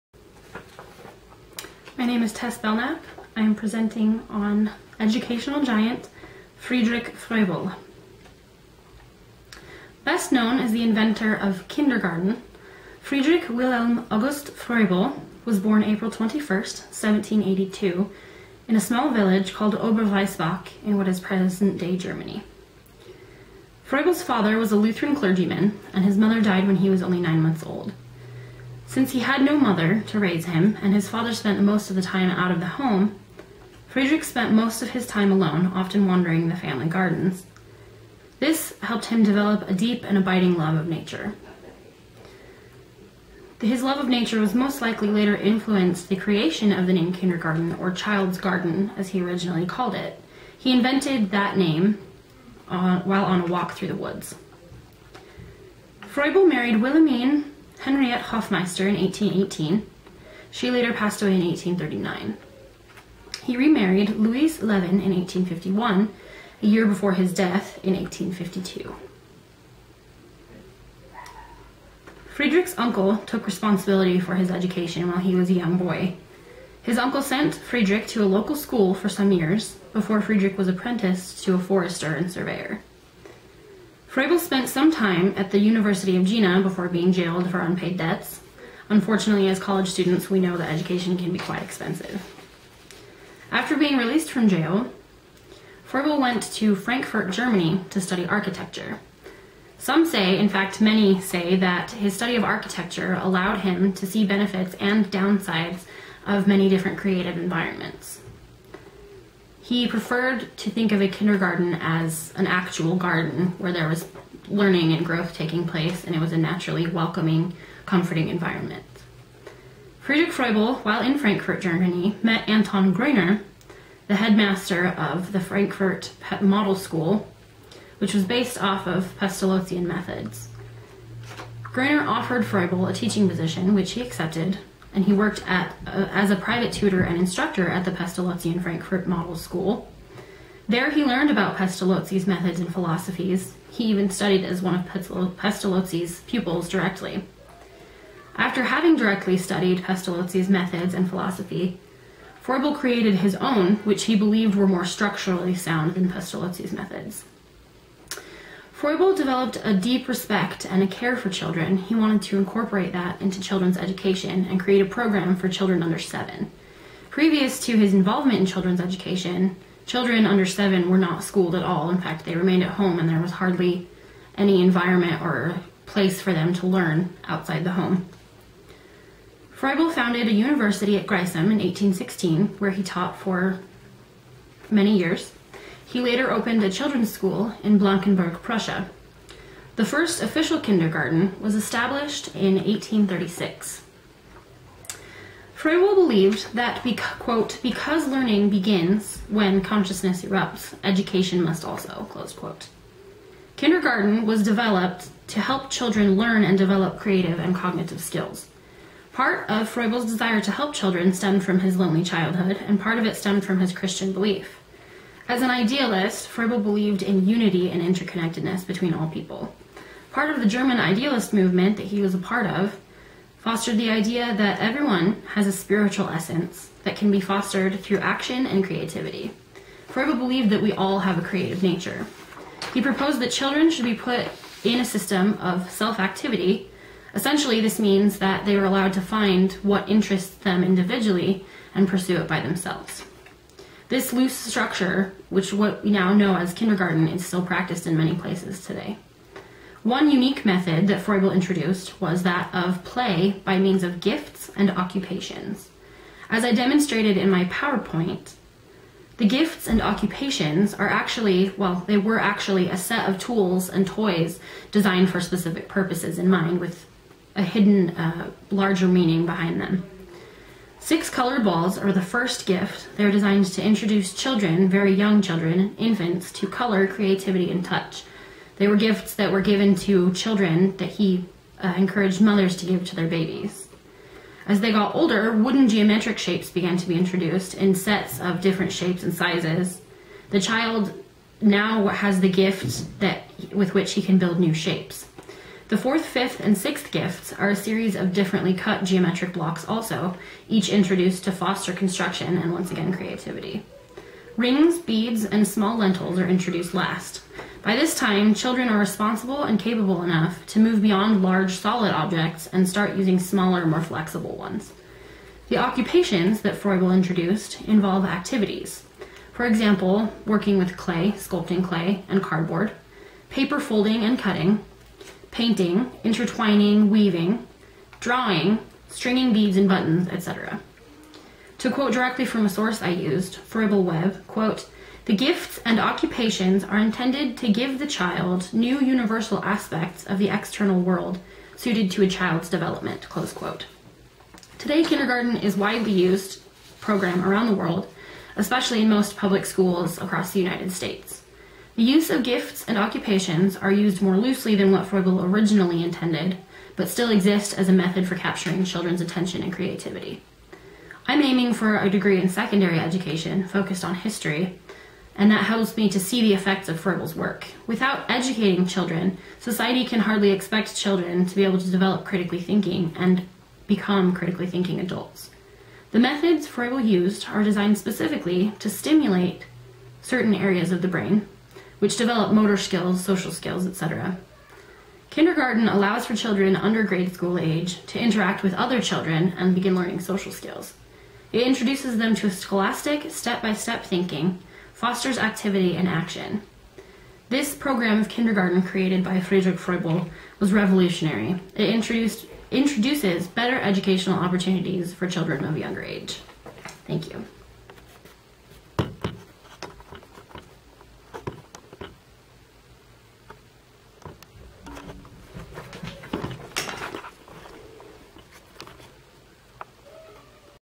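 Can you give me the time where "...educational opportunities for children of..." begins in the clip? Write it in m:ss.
6:43.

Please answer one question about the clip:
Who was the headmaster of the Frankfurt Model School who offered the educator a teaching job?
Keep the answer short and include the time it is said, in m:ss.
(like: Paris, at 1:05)
Anton Greiner, at 2:02.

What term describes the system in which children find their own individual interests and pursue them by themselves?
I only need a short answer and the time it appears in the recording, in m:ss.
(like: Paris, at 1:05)
self activity, at 3:55.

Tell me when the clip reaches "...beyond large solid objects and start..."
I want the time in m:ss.
5:10.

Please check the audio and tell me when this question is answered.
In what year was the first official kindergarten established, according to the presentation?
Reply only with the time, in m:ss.
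3:12.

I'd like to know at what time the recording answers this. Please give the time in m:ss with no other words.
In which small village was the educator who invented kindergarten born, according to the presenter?
0:19.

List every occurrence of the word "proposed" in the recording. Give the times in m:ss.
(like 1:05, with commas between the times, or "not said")
3:52.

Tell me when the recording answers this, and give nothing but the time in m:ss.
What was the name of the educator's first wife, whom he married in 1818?
0:56.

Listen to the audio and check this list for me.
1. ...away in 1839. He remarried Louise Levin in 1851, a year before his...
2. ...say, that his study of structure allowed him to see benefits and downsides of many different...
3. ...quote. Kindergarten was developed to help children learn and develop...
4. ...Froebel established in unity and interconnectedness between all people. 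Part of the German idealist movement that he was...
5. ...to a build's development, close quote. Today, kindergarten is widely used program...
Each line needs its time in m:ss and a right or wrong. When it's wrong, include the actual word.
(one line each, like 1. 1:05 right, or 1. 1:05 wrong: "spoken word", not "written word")
1. 1:01 right
2. 1:41 wrong: "architecture", not "structure"
3. 3:22 right
4. 3:36 wrong: "believed", not "established"
5. 5:41 wrong: "child", not "build".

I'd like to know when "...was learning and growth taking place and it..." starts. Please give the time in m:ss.
1:53.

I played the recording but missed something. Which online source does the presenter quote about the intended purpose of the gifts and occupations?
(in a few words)
Froebel Web.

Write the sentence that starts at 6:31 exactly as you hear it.
It introduces them to scholastic, step by step thinking, fosters activity and action.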